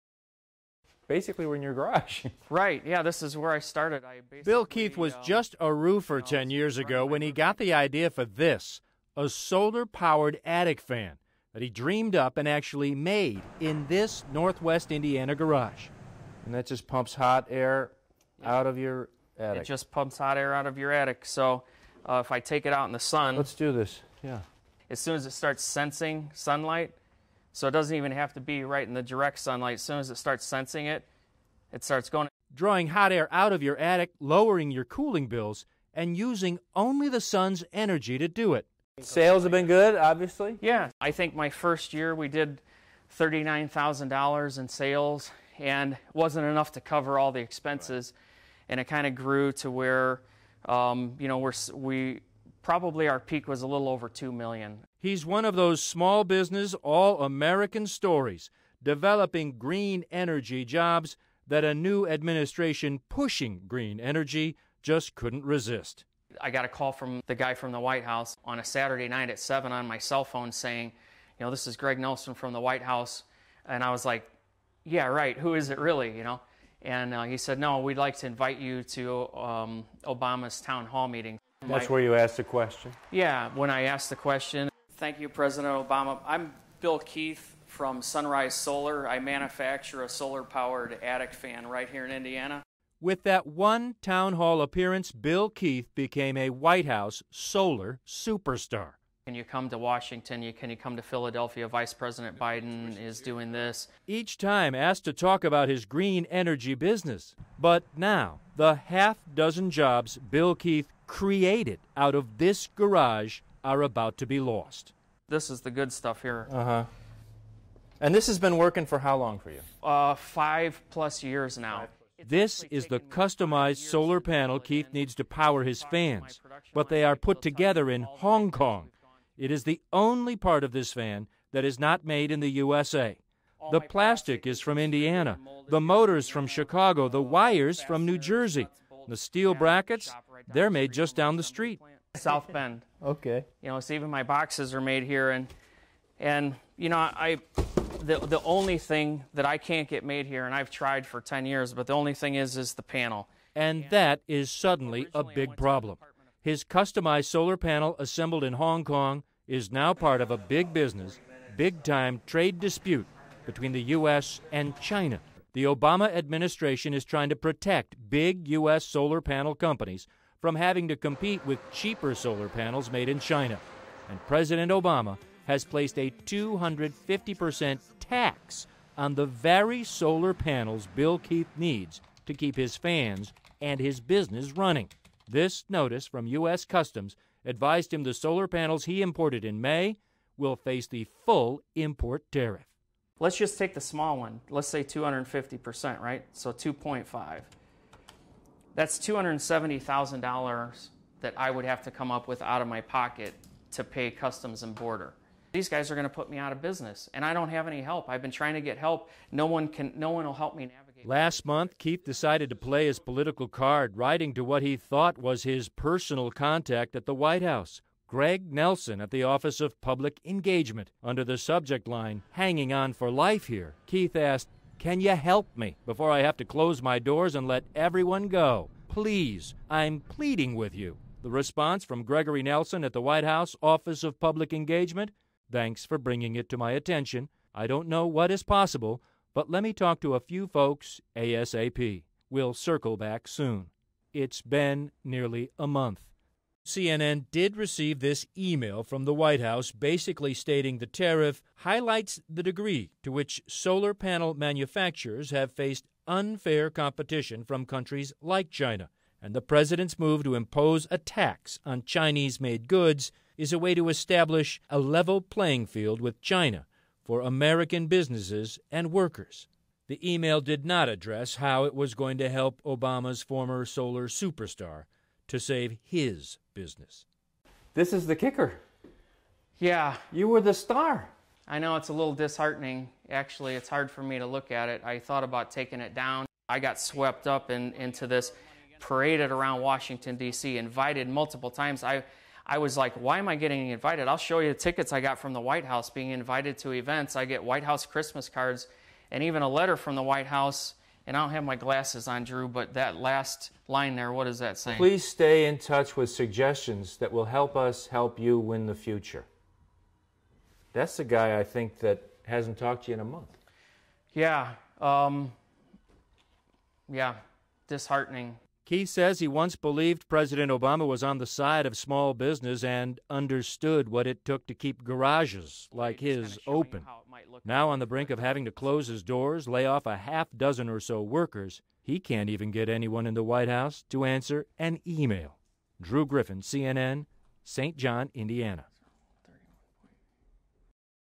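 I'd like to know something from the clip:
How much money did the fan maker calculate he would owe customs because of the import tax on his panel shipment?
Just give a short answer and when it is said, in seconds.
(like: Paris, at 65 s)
$270,000, at 198 s.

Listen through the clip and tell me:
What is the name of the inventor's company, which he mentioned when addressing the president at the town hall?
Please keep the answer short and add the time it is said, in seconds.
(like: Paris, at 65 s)
Sunrise Solar, at 88 s.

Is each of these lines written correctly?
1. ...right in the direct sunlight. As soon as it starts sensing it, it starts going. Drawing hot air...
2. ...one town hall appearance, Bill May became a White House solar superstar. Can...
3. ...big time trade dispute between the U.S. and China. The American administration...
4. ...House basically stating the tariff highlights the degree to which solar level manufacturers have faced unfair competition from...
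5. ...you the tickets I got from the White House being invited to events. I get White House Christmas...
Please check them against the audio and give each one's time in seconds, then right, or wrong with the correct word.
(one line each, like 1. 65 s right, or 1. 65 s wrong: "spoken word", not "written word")
1. 28 s right
2. 93 s wrong: "Keith", not "May"
3. 161 s wrong: "Obama", not "American"
4. 249 s wrong: "panel", not "level"
5. 294 s right.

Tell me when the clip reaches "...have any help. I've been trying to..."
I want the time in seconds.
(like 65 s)
207 s.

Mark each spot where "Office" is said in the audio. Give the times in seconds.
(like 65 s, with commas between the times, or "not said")
219 s, 233 s.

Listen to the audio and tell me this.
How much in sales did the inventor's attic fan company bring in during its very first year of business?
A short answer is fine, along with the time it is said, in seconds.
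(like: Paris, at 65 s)
$39,000, at 43 s.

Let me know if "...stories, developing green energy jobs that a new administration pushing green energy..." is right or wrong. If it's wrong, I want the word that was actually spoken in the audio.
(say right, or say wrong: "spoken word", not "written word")
right.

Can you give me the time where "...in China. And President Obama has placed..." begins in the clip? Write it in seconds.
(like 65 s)
173 s.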